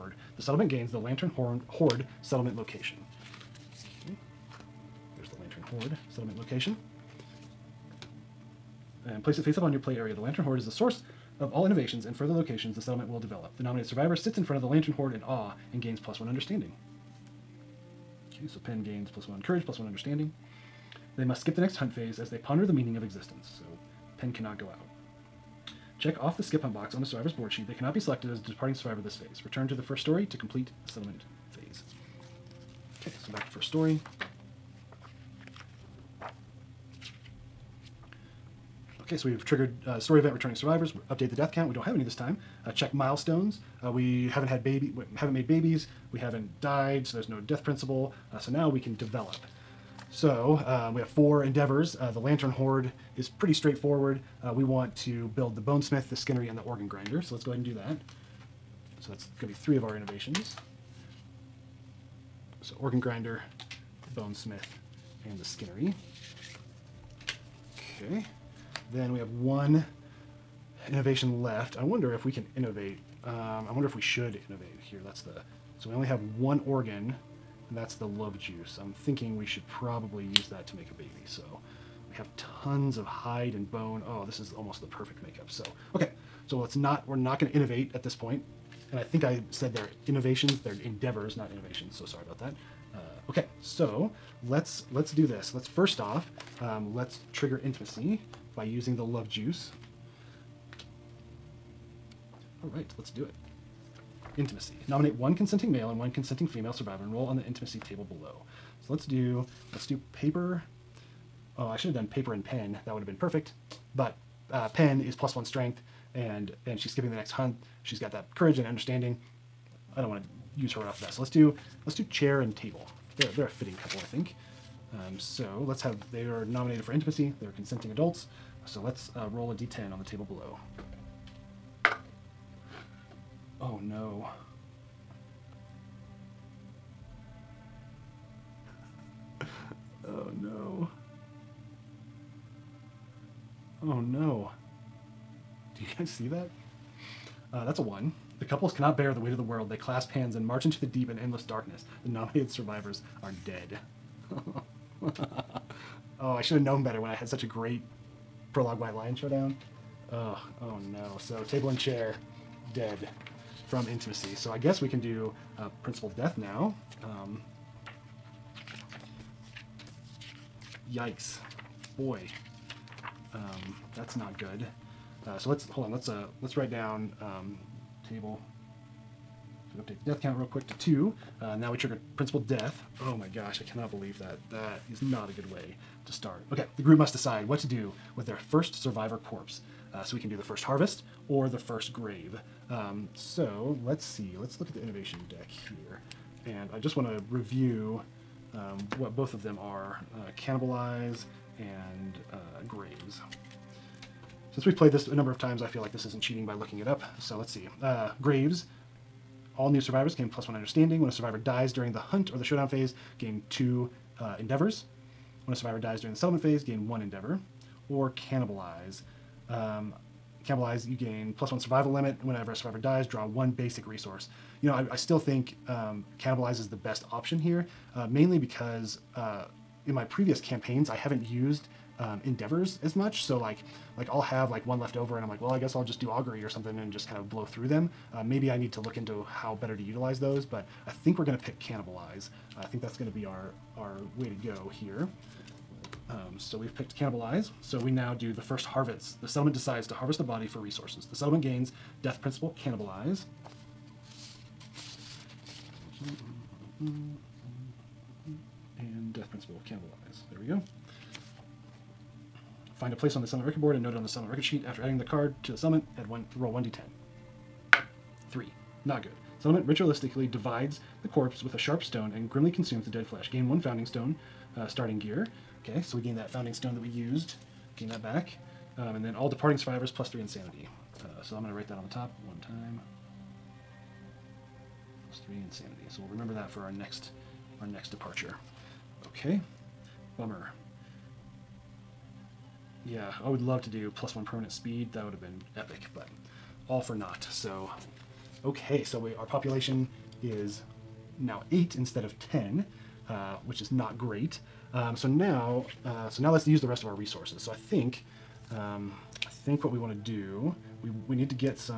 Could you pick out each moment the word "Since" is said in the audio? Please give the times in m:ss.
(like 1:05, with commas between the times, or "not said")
3:24.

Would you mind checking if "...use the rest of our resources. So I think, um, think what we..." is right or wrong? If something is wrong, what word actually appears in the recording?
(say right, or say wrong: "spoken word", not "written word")
right.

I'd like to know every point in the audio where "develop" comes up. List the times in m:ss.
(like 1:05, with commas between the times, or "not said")
0:13, 0:48.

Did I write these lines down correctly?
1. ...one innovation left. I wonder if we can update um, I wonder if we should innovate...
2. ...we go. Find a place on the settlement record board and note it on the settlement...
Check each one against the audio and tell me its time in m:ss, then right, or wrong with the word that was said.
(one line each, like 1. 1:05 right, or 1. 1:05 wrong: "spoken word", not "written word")
1. 1:09 wrong: "innovate", not "update"
2. 4:20 right.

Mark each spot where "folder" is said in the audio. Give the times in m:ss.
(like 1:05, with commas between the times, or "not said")
not said.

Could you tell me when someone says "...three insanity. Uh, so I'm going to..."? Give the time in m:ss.
4:40.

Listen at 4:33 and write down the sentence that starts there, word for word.
Gain one founding stone, uh, starting gear.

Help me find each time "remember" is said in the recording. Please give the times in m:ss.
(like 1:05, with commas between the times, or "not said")
4:46.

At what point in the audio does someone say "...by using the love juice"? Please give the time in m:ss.
1:38.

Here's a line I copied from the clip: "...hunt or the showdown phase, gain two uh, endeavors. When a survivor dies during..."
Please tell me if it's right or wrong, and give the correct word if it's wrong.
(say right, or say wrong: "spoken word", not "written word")
right.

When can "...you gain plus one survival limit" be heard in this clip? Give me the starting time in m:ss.
3:40.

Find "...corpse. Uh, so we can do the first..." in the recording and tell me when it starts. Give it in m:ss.
3:09.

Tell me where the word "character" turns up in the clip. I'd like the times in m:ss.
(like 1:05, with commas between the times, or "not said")
not said.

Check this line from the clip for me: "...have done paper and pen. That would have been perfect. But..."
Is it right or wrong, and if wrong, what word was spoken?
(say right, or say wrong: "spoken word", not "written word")
right.